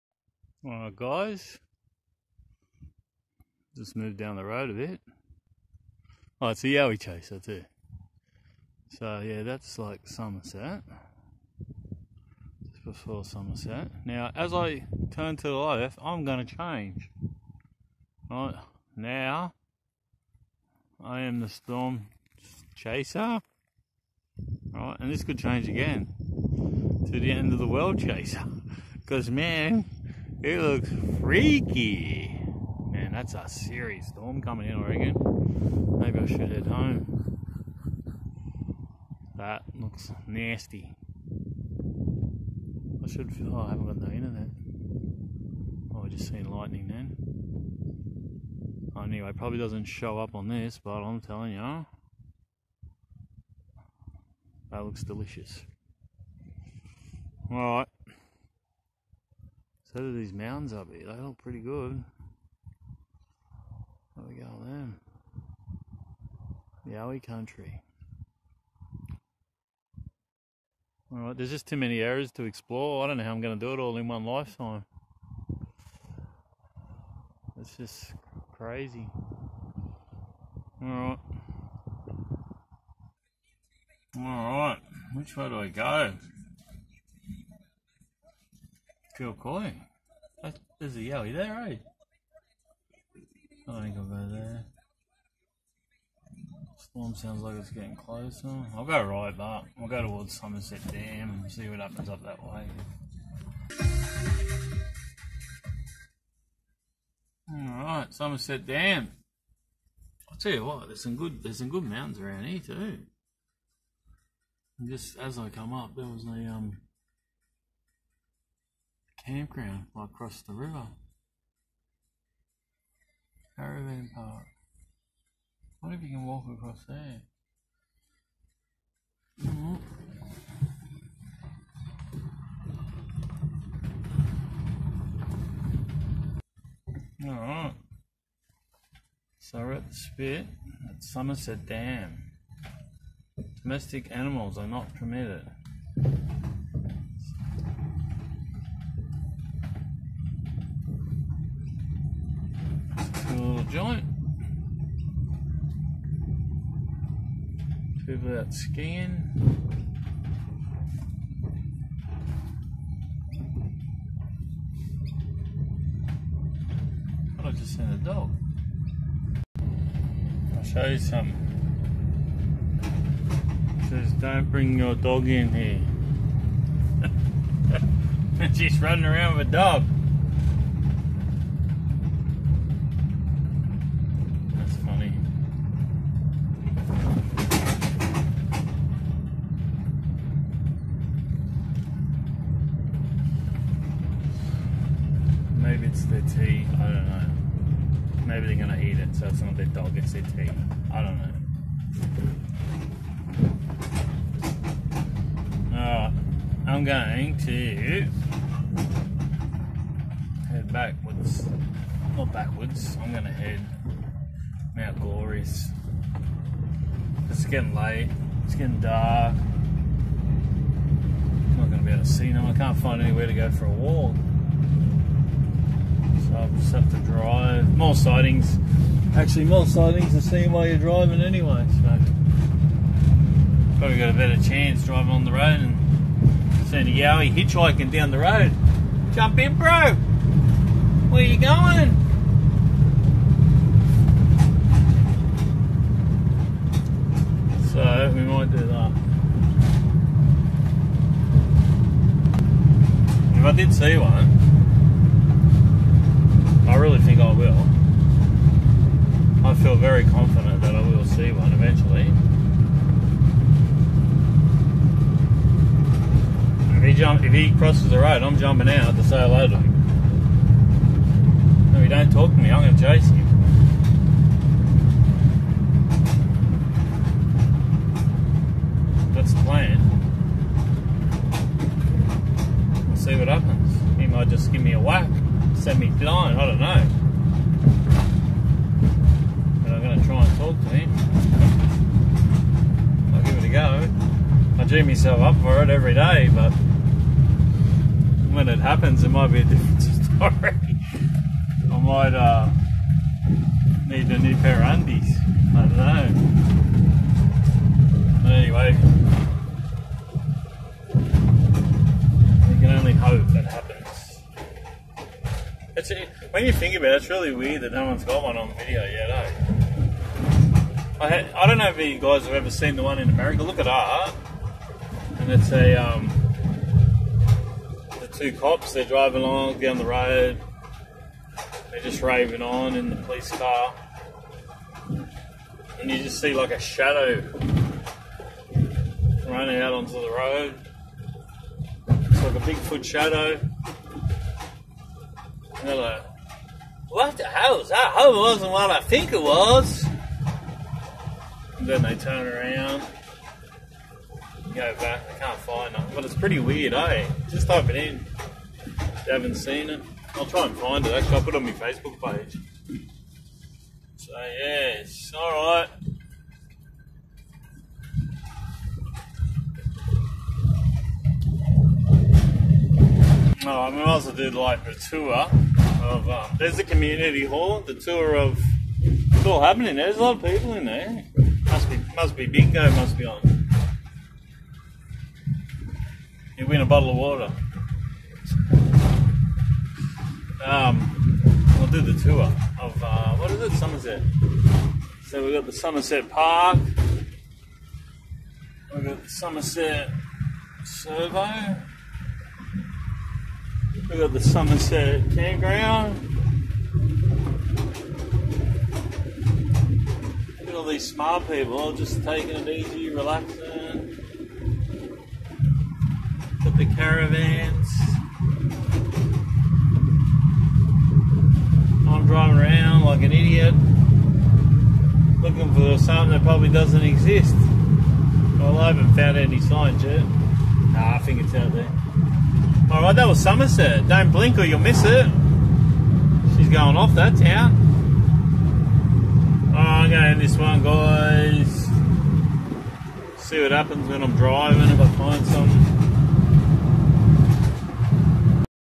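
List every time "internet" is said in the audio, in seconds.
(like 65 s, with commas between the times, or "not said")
44 s.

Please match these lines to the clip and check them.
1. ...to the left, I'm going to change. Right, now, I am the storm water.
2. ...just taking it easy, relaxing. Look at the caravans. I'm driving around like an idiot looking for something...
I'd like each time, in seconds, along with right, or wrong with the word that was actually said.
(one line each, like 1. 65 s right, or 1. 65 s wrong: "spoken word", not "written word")
1. 15 s wrong: "chaser", not "water"
2. 411 s right.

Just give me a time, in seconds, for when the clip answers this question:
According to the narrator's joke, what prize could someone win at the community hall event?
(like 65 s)
386 s.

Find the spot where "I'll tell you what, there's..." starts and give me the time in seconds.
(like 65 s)
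110 s.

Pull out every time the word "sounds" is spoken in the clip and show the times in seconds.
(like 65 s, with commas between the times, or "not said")
97 s.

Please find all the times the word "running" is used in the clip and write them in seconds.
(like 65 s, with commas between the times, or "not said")
178 s, 339 s.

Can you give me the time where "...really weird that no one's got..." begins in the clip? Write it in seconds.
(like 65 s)
317 s.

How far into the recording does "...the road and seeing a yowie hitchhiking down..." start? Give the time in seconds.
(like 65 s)
235 s.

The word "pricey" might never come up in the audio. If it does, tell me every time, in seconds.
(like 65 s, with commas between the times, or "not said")
not said.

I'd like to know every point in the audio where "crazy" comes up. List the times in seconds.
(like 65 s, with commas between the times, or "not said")
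78 s.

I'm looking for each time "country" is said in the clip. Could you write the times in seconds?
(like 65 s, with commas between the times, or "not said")
67 s.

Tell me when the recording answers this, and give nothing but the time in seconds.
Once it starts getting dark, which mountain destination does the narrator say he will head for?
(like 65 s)
214 s.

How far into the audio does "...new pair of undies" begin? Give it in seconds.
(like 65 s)
304 s.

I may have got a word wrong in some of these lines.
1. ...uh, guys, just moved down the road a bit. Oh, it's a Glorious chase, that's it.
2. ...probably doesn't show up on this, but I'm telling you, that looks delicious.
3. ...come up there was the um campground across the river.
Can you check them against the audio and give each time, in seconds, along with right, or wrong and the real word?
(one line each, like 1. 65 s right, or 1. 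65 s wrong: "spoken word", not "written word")
1. 0 s wrong: "Yowie", not "Glorious"
2. 49 s right
3. 115 s right.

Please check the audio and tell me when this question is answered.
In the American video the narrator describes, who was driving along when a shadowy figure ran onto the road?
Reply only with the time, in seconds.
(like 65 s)
327 s.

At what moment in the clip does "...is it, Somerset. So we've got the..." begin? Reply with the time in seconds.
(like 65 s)
393 s.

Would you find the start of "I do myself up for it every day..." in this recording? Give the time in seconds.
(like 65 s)
294 s.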